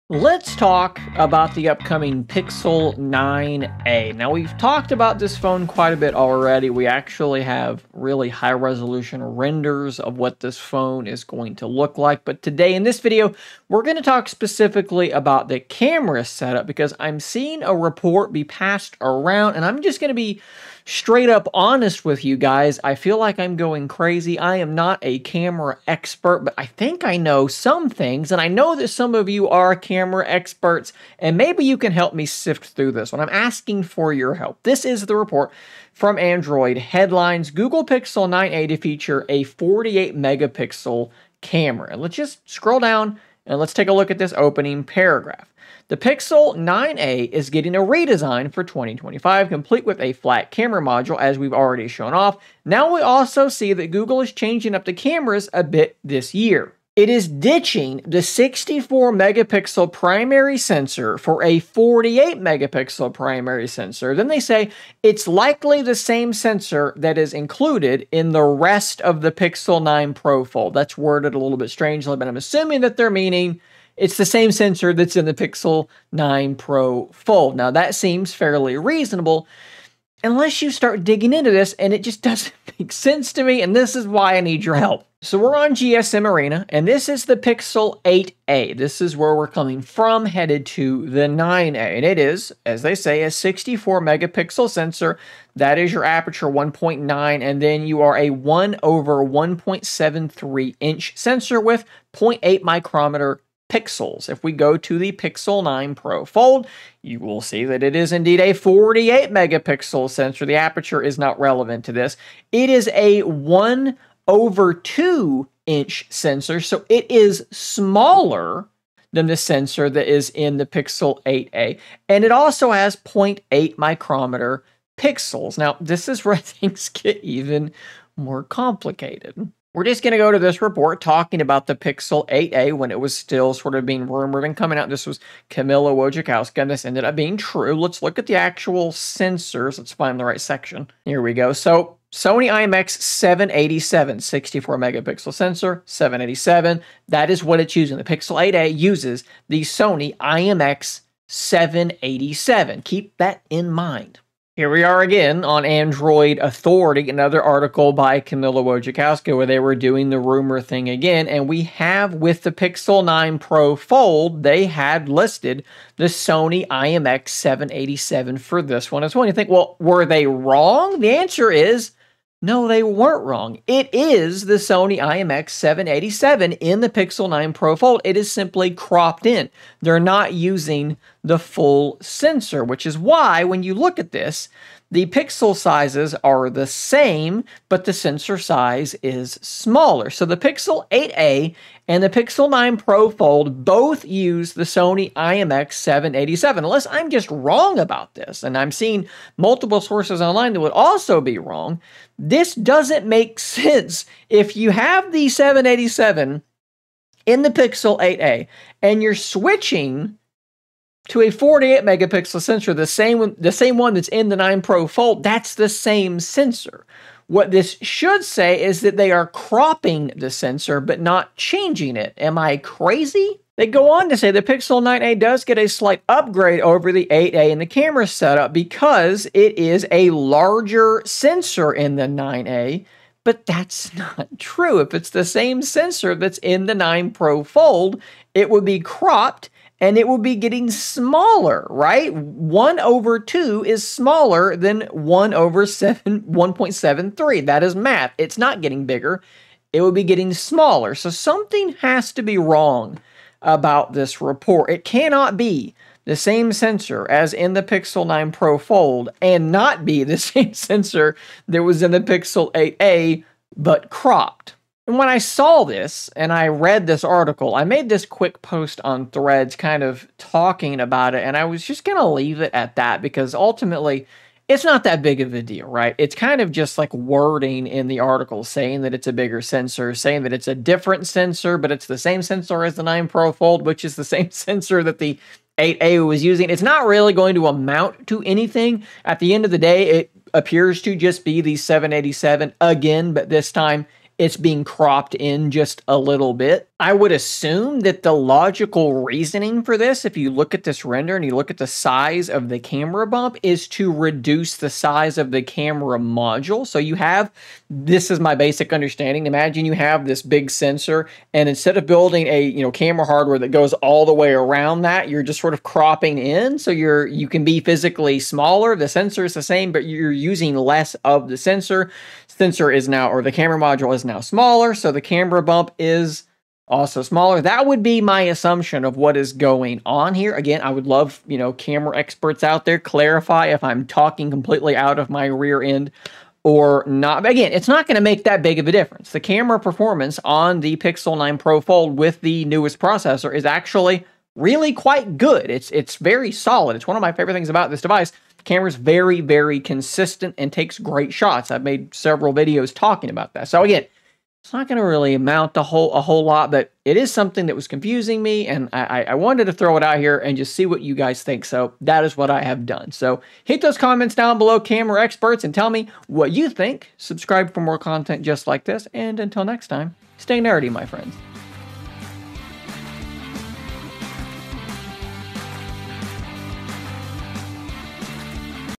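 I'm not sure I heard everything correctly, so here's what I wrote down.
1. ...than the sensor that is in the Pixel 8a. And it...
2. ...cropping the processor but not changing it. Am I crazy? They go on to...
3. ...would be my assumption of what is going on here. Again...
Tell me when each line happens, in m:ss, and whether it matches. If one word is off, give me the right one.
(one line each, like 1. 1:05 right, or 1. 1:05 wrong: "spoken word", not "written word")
1. 1:59 right
2. 3:39 wrong: "sensor", not "processor"
3. 5:27 right.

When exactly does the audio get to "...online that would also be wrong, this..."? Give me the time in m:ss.
3:20.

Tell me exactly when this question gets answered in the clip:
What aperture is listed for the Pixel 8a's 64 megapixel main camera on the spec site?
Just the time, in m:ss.
1:36.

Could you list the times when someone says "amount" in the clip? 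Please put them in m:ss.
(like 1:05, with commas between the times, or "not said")
4:47, 5:55.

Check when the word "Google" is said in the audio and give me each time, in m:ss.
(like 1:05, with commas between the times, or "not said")
0:37, 0:53.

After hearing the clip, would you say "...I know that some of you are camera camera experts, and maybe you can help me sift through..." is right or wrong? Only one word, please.
right.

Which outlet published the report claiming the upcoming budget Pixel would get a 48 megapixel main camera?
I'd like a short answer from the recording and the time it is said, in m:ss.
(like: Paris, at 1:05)
Android Headlines, at 0:36.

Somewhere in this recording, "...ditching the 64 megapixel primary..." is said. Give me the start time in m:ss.
0:57.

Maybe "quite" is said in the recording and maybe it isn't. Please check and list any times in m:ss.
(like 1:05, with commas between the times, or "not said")
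0:05, 5:44.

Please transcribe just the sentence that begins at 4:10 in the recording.
So something has to be wrong about this report.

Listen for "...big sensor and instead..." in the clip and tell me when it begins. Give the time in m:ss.
5:10.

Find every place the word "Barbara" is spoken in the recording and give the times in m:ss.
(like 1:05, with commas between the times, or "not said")
not said.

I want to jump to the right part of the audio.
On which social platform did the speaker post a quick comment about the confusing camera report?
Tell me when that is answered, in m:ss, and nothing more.
4:29.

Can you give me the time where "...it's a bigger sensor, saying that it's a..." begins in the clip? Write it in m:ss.
4:38.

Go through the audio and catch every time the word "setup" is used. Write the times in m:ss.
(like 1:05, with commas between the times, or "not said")
0:16, 3:48.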